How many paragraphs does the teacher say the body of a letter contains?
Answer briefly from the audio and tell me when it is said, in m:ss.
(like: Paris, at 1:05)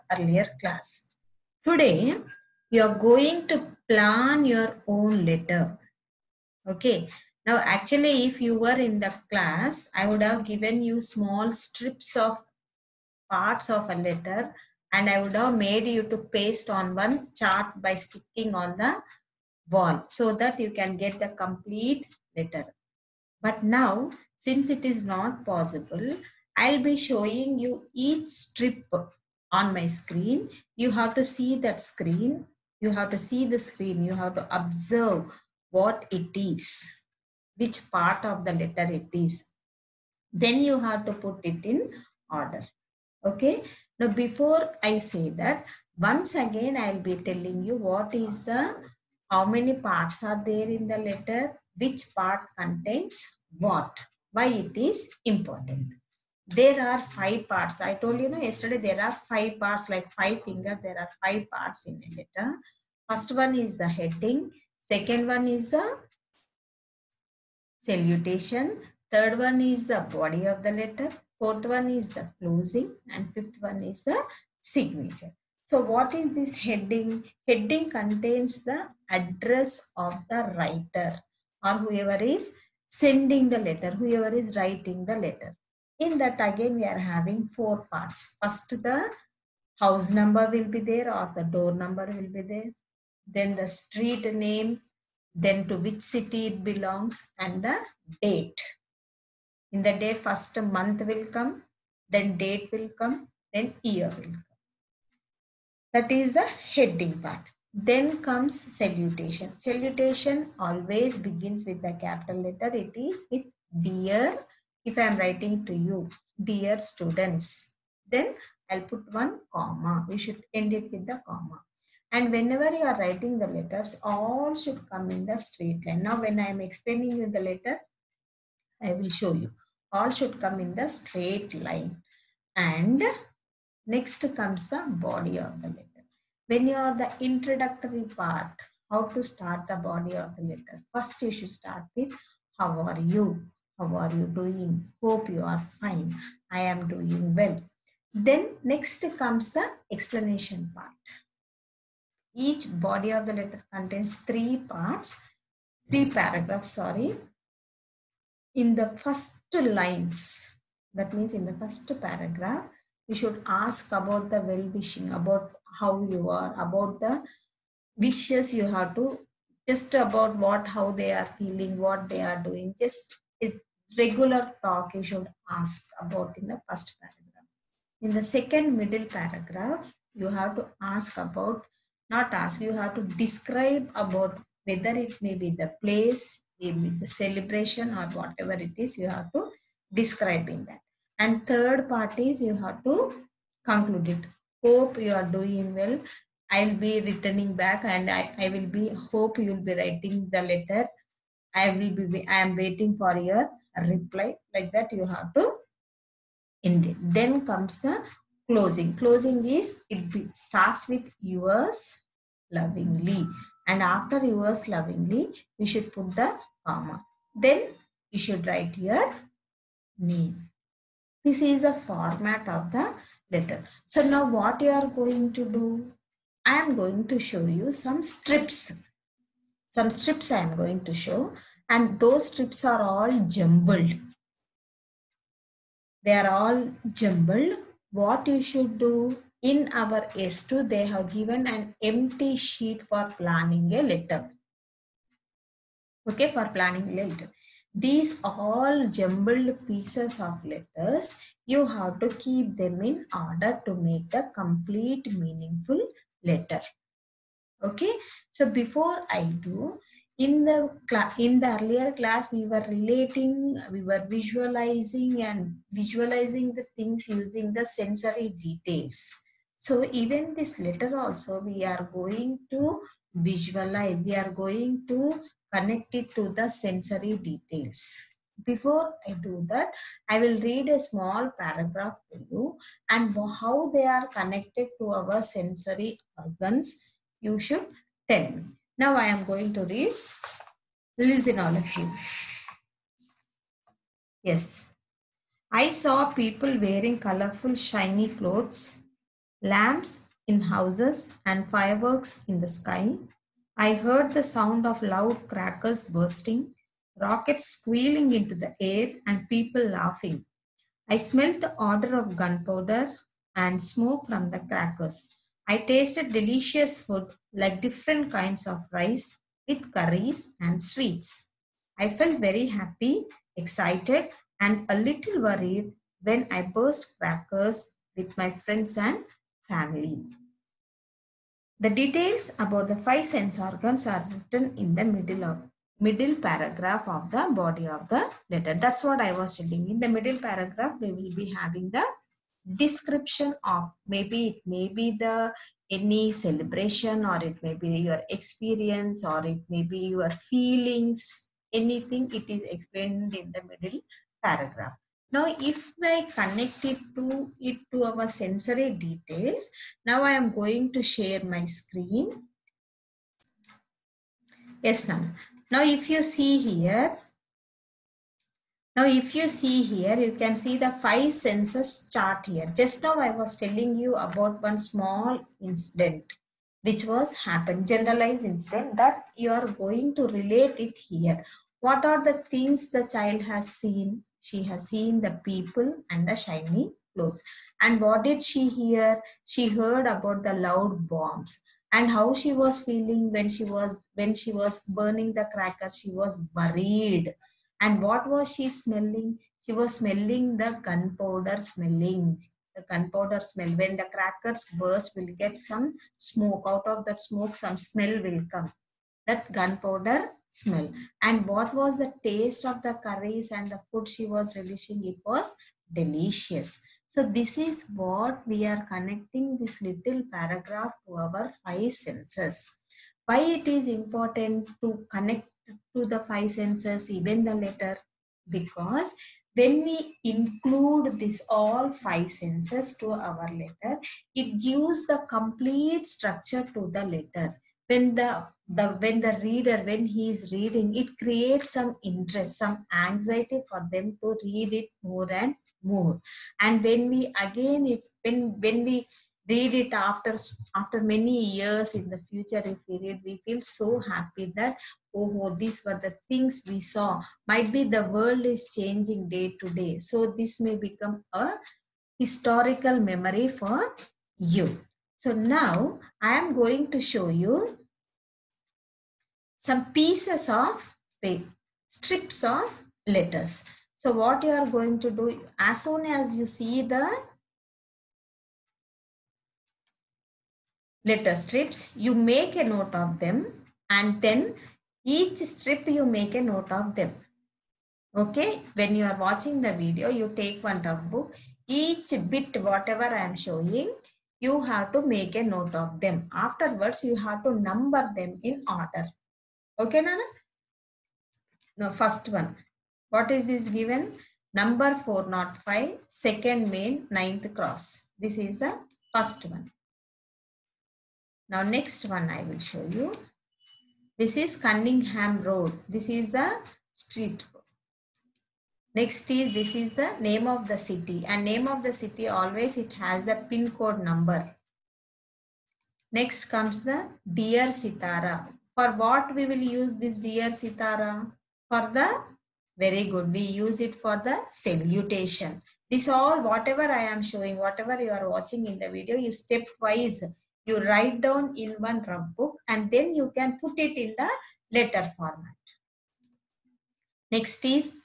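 3, at 2:35.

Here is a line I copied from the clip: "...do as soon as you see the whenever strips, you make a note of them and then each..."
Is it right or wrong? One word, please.
wrong.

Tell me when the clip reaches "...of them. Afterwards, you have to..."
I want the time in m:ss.
8:15.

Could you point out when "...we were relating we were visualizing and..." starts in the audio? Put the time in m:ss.
4:22.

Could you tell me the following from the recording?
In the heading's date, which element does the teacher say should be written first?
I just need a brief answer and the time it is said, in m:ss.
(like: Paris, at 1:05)
month, at 1:40.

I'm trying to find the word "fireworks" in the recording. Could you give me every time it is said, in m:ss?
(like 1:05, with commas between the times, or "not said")
5:01.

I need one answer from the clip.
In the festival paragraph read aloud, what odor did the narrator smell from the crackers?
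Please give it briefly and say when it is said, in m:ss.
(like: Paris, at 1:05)
gunpowder and smoke, at 5:12.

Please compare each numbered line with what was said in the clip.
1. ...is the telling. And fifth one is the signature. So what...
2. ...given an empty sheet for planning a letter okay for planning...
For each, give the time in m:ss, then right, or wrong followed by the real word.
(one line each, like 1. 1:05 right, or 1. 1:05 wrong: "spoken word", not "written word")
1. 1:11 wrong: "closing", not "telling"
2. 4:01 right.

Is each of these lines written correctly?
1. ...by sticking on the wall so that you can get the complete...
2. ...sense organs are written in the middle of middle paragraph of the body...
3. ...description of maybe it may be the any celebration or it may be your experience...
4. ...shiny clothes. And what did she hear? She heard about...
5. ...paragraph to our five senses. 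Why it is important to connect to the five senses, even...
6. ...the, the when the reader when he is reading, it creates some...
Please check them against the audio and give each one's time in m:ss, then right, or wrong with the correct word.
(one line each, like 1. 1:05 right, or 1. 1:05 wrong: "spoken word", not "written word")
1. 0:17 right
2. 5:33 right
3. 5:42 right
4. 6:26 right
5. 7:00 right
6. 7:17 right.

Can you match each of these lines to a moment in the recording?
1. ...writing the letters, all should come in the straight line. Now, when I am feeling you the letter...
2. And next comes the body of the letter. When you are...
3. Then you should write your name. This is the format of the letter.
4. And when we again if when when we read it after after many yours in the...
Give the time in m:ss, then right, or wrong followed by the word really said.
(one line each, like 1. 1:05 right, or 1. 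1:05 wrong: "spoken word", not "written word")
1. 2:02 wrong: "explaining", not "feeling"
2. 2:12 right
3. 3:37 right
4. 7:26 wrong: "years", not "yours".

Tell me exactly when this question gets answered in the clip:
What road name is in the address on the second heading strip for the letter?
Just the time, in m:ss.
8:34.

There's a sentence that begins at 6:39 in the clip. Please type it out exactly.
She was smelling the gunpowder smelling.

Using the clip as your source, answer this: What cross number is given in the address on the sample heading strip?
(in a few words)
9.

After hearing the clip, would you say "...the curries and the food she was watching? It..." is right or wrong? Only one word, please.
wrong.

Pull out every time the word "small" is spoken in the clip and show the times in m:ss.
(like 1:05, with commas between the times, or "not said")
0:11, 4:40, 6:14.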